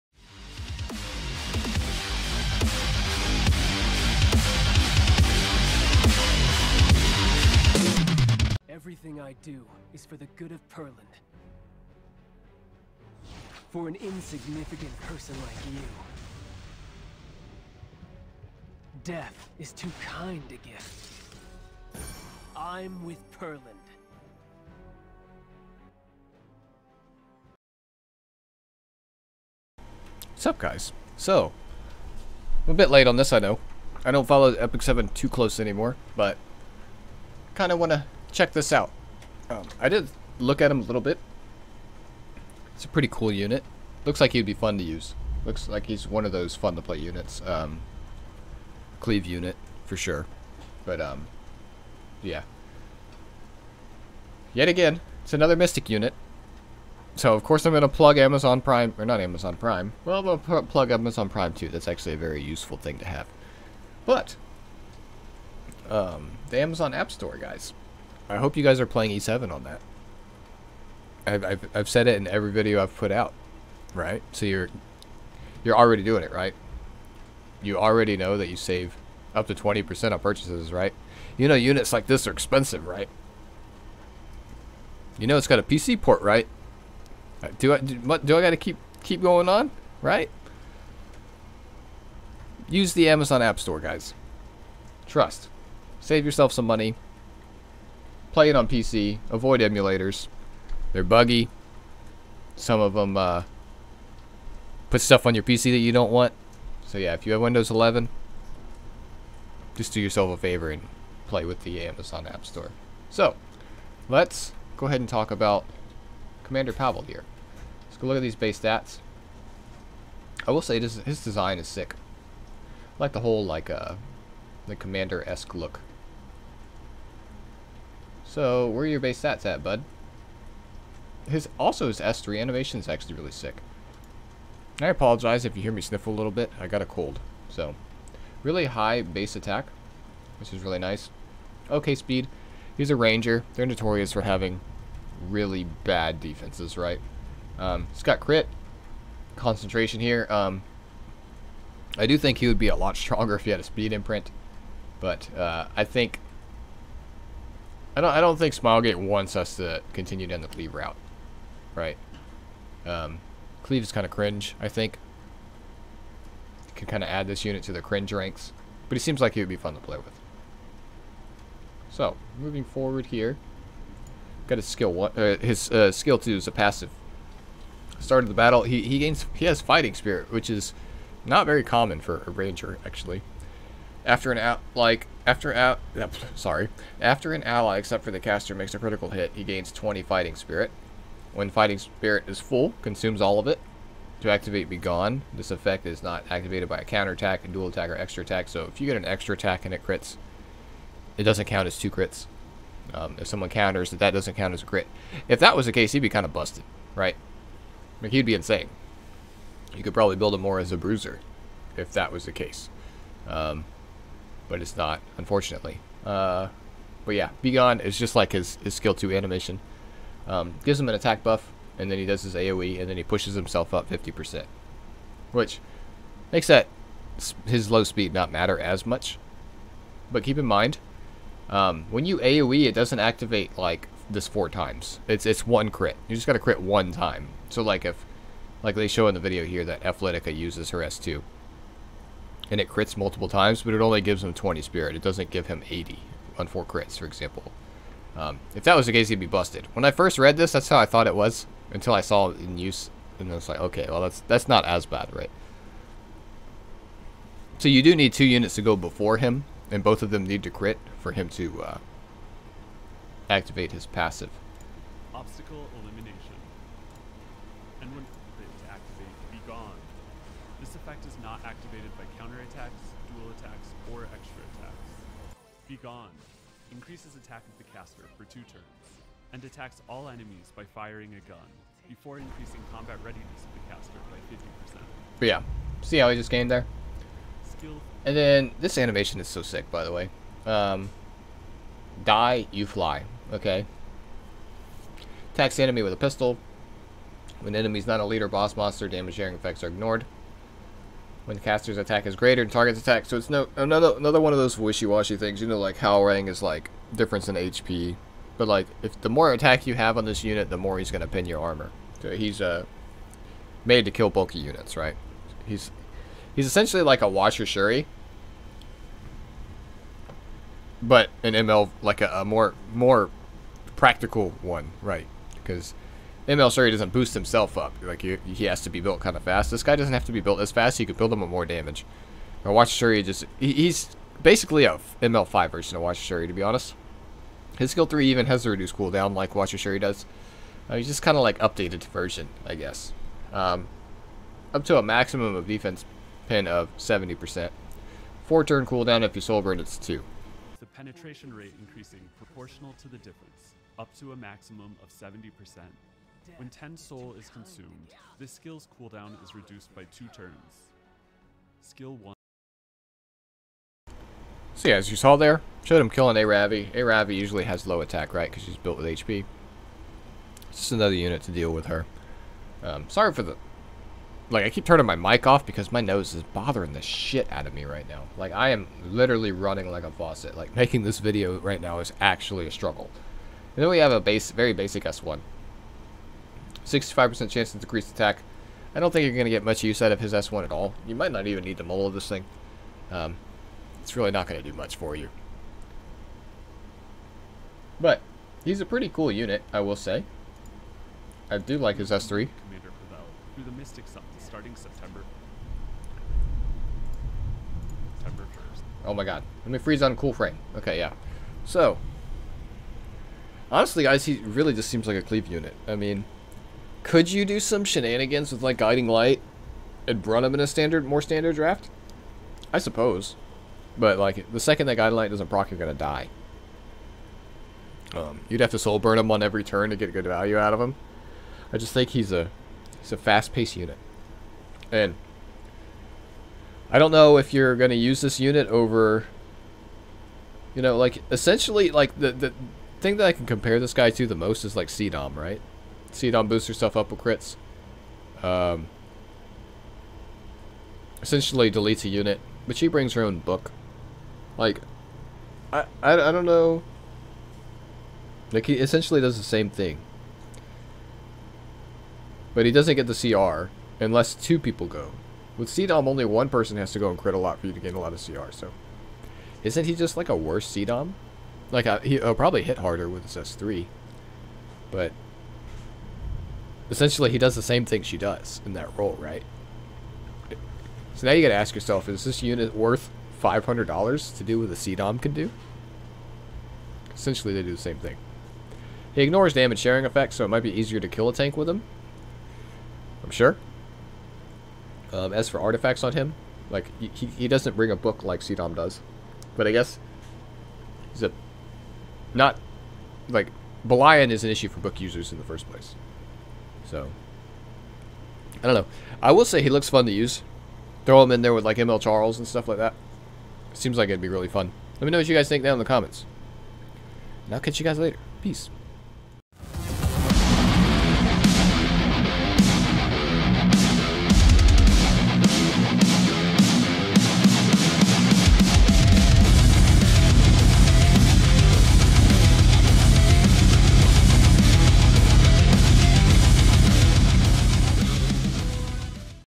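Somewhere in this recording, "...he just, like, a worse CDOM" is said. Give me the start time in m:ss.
7:49.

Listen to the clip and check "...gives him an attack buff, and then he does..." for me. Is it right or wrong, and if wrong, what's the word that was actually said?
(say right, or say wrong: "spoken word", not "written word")
right.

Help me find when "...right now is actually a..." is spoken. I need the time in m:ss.
6:21.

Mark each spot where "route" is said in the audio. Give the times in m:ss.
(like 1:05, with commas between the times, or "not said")
2:40.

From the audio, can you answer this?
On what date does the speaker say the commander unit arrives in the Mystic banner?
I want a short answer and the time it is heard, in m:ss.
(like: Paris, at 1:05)
September 1st, at 6:48.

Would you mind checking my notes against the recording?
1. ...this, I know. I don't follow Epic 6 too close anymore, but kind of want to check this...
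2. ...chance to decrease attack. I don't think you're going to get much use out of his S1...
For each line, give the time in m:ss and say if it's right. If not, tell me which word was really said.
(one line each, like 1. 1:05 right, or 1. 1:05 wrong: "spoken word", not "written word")
1. 0:33 wrong: "7", not "6"
2. 6:27 right.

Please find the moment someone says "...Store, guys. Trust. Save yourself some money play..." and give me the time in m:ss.
1:33.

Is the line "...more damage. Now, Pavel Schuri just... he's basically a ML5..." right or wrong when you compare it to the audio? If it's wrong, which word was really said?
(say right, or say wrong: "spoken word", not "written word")
wrong: "Watch", not "Pavel".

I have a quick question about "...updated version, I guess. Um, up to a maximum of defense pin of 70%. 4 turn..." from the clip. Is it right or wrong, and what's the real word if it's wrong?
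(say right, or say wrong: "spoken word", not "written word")
right.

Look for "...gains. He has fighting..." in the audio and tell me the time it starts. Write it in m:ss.
2:58.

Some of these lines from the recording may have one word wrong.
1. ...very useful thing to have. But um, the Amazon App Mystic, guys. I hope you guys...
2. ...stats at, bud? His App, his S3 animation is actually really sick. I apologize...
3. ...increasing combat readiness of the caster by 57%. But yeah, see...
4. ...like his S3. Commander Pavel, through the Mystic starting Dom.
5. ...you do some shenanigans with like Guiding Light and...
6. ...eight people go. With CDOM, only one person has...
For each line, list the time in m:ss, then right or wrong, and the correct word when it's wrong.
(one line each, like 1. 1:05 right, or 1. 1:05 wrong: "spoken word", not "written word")
1. 1:02 wrong: "Store", not "Mystic"
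2. 2:09 wrong: "Also", not "App"
3. 4:42 wrong: "50", not "57"
4. 6:41 wrong: "September", not "Dom"
5. 6:57 right
6. 7:44 wrong: "two", not "eight".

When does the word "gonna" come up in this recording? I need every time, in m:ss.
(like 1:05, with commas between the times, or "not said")
5:10, 7:05.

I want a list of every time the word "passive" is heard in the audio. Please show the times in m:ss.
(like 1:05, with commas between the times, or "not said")
2:56, 4:23.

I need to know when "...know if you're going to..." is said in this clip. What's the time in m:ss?
7:16.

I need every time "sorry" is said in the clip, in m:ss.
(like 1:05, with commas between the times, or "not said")
3:06, 6:12.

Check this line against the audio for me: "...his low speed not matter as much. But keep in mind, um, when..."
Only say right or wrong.
right.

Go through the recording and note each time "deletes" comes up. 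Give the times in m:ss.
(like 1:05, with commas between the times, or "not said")
7:31.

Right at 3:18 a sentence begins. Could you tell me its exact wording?
So if you get an extra attack and it crits, it doesn't count as two crits.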